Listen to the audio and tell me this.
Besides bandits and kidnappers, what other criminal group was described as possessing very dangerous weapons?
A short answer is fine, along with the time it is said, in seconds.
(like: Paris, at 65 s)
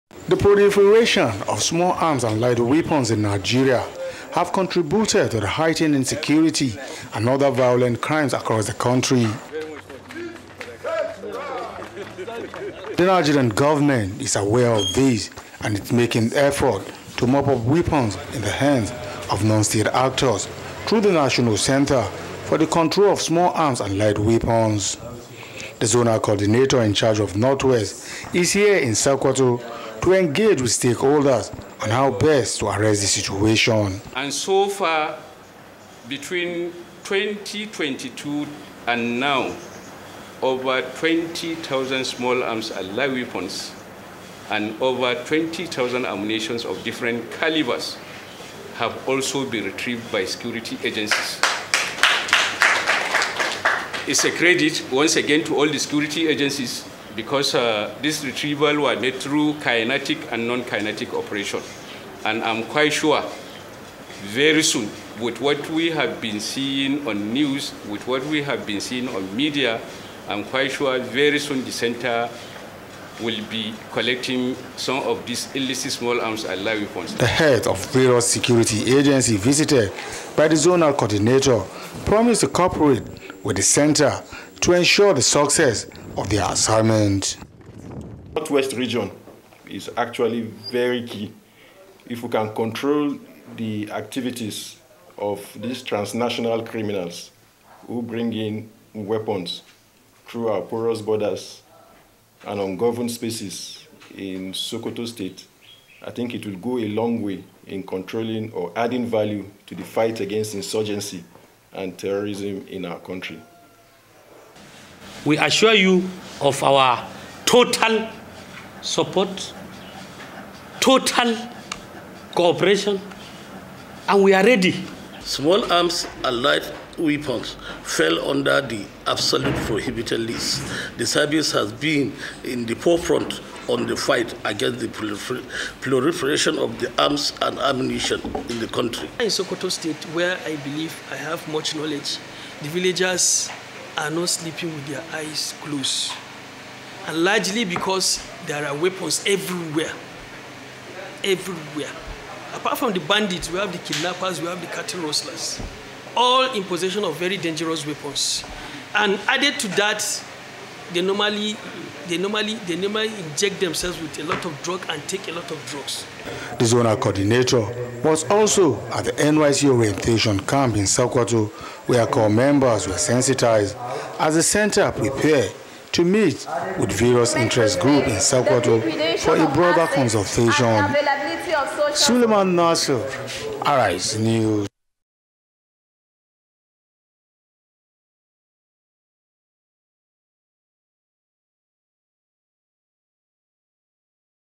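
cattle rustlers, at 154 s.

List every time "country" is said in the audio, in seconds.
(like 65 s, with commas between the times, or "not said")
8 s, 112 s, 138 s.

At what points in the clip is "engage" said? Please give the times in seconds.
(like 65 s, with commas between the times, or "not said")
30 s.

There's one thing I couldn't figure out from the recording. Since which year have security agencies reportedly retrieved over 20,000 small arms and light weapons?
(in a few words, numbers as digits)
2022.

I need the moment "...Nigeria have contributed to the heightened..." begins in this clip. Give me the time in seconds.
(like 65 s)
3 s.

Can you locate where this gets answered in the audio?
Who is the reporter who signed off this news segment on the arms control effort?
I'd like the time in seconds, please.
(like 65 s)
181 s.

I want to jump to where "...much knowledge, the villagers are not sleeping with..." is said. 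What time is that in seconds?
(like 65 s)
141 s.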